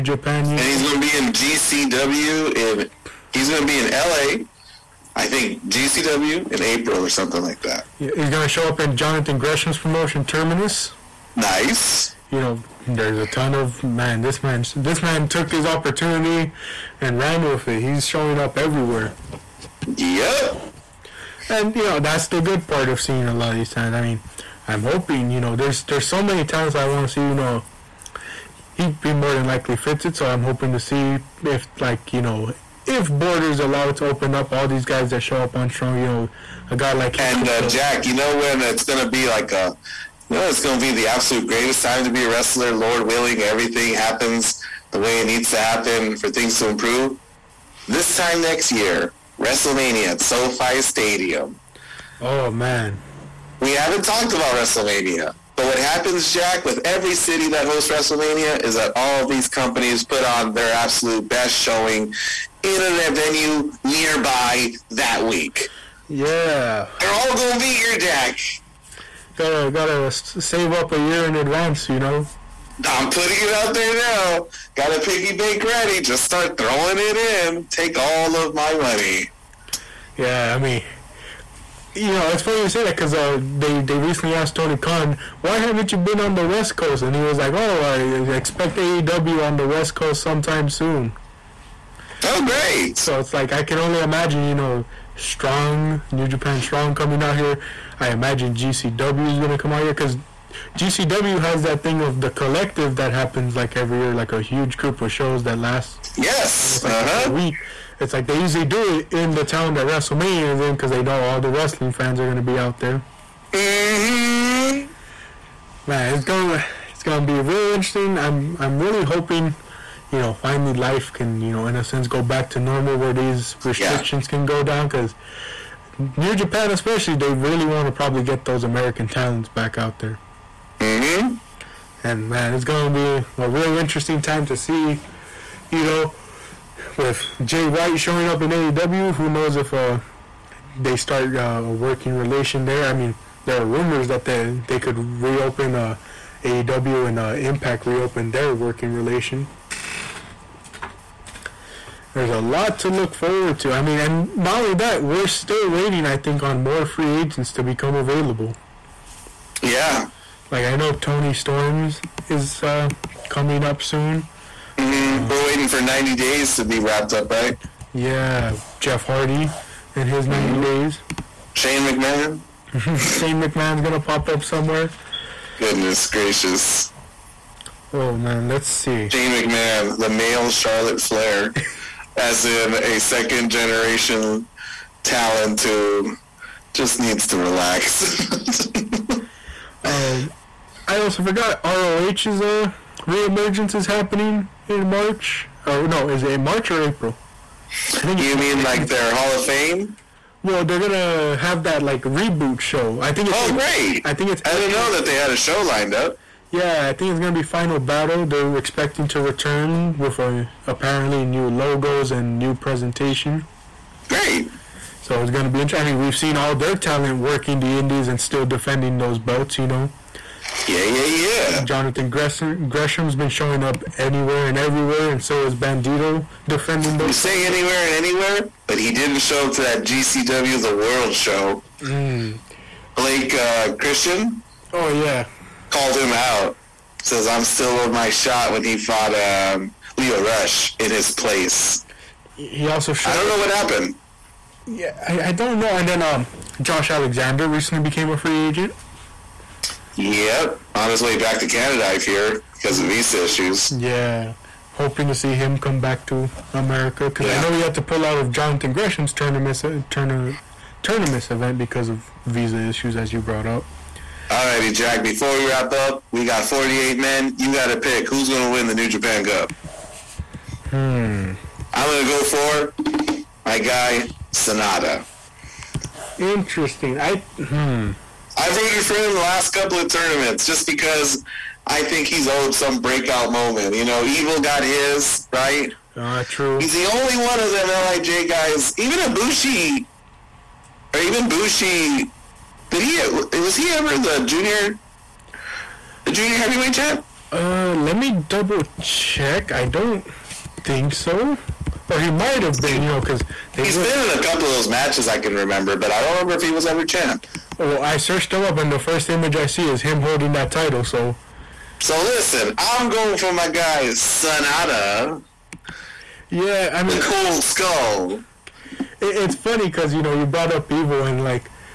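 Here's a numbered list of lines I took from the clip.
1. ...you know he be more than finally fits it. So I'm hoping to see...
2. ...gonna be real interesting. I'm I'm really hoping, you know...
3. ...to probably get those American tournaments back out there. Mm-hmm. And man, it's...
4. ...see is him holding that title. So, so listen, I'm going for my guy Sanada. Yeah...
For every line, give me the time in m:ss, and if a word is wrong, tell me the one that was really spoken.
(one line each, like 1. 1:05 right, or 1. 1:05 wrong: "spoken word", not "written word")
1. 0:27 wrong: "likely", not "finally"
2. 1:57 right
3. 2:07 wrong: "talents", not "tournaments"
4. 5:09 right.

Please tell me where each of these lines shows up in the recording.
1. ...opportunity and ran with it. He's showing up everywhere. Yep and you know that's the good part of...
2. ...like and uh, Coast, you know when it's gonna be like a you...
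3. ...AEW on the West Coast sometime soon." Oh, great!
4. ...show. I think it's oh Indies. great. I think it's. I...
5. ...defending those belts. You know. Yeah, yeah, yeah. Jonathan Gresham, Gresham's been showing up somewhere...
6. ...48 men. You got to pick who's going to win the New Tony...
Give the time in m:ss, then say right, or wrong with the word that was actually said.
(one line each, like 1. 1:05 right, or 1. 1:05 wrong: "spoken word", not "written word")
1. 0:15 right
2. 0:36 wrong: "Jack", not "Coast"
3. 1:28 right
4. 3:22 wrong: "April", not "Indies"
5. 3:38 wrong: "anywhere", not "somewhere"
6. 4:26 wrong: "Japan", not "Tony".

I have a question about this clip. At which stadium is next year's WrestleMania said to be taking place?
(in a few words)
SoFi Stadium.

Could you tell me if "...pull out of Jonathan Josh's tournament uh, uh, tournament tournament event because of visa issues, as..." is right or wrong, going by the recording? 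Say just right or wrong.
wrong.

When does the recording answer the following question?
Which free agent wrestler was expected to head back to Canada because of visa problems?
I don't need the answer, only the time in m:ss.
4:06.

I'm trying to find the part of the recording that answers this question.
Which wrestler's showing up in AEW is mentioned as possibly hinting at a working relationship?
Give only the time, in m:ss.
2:17.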